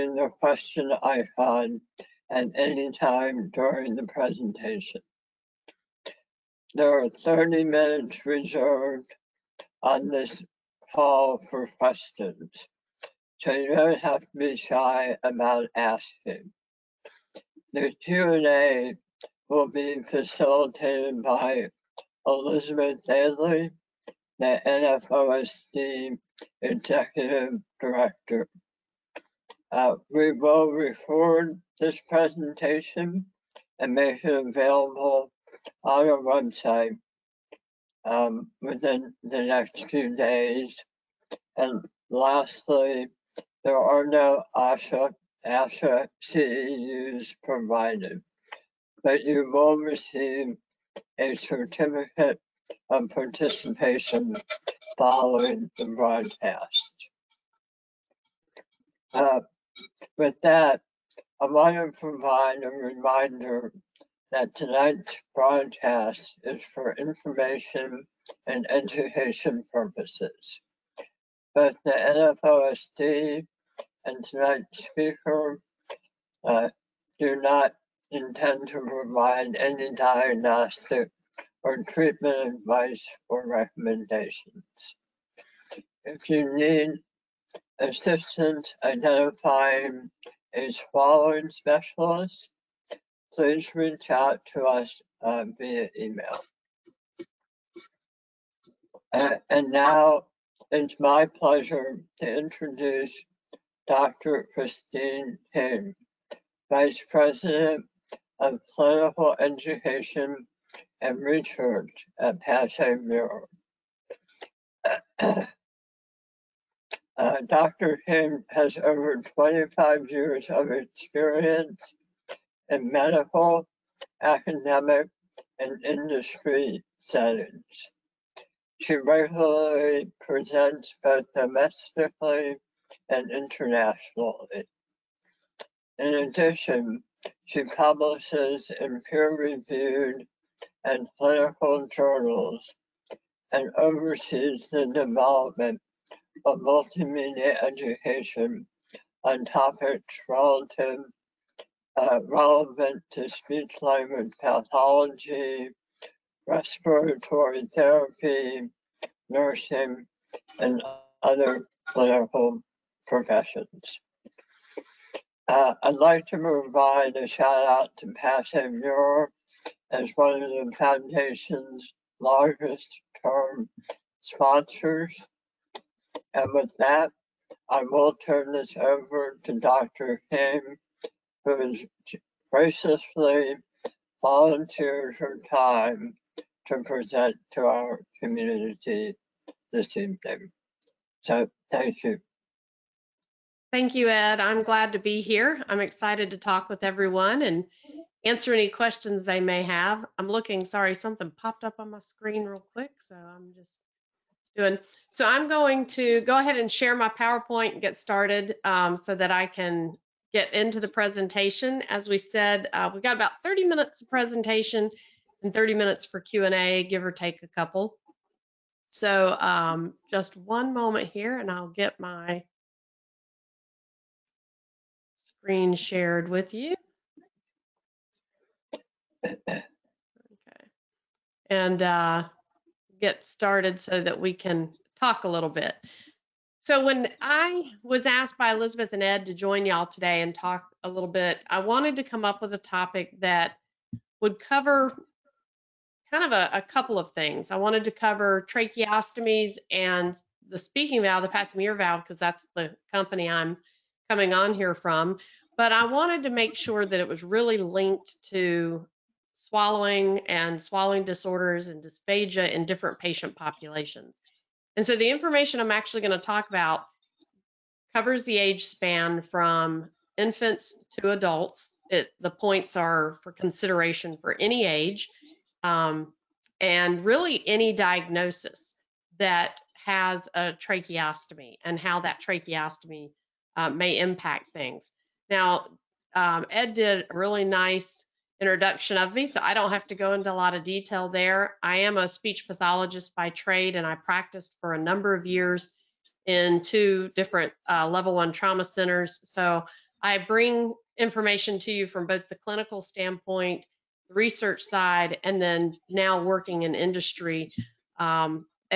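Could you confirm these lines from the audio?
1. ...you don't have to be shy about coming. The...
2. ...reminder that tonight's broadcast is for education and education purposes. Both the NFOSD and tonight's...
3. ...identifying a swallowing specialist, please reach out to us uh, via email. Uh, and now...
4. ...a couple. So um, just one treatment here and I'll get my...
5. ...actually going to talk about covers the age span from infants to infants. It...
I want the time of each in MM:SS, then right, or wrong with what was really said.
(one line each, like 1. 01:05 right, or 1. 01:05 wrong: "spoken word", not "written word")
1. 00:13 wrong: "asking", not "coming"
2. 01:02 wrong: "information", not "education"
3. 01:28 right
4. 03:37 wrong: "moment", not "treatment"
5. 04:25 wrong: "adults", not "infants".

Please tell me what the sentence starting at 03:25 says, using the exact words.
So I'm going to go ahead and share my PowerPoint and get started um, so that I can get into the presentation.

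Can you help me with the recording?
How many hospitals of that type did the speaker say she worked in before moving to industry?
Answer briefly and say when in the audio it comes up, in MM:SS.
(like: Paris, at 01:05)
2, at 04:56.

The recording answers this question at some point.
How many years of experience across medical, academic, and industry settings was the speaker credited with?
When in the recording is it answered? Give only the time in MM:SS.
01:59.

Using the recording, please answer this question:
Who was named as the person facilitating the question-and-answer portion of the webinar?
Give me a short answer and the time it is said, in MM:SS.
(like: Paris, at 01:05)
Elizabeth Daly, at 00:22.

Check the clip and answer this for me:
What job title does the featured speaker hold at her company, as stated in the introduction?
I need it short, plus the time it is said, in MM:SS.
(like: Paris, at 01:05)
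Vice President of Clinical Education and Research, at 01:46.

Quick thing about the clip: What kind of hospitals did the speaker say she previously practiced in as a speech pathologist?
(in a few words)
level one trauma centers.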